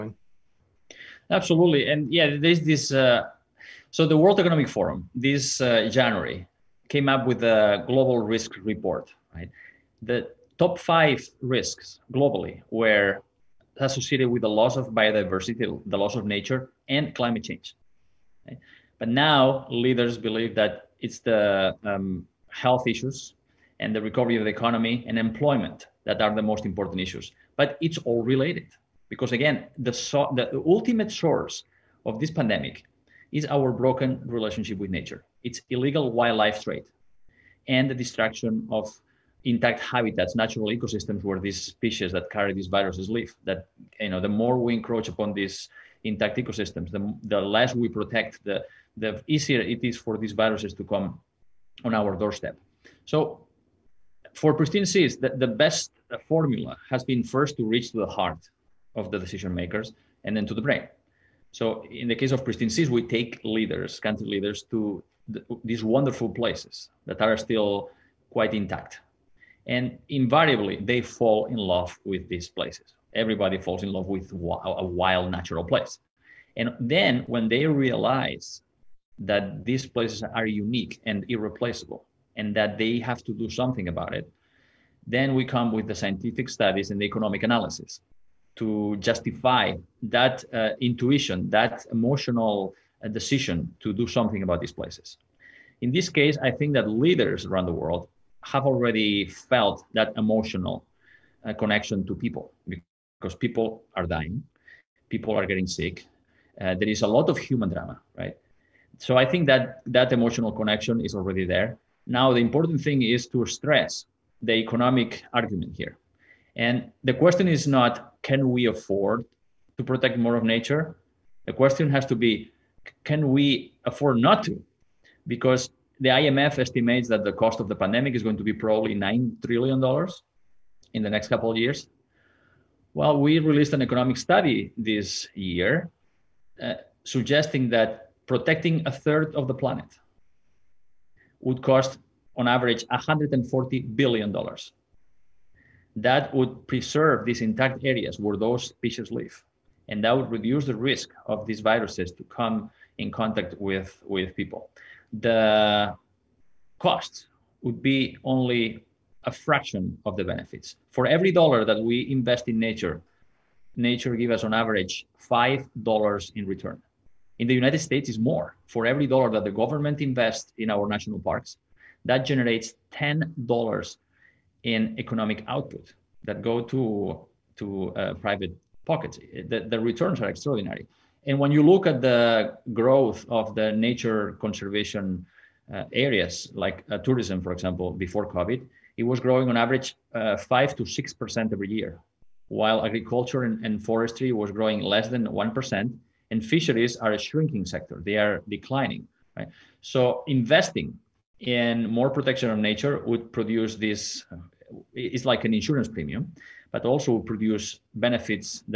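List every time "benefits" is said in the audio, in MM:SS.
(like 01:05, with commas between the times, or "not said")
02:40, 03:27.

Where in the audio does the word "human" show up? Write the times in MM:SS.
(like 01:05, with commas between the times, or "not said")
01:47.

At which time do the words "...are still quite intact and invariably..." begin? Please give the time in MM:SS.
01:07.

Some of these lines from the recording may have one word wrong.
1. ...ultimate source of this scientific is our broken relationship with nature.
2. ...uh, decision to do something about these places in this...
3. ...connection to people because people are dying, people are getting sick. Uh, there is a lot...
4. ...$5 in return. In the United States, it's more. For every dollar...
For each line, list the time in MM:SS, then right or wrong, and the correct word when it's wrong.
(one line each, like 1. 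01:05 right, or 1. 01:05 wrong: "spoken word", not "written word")
1. 00:30 wrong: "pandemic", not "scientific"
2. 01:33 right
3. 01:41 right
4. 02:45 right.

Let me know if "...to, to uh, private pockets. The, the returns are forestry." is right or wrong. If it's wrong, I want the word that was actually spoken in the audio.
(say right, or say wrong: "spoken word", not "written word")
wrong: "extraordinary", not "forestry".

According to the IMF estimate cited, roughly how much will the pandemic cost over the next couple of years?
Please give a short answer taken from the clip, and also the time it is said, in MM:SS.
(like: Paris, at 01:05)
$9 trillion, at 02:08.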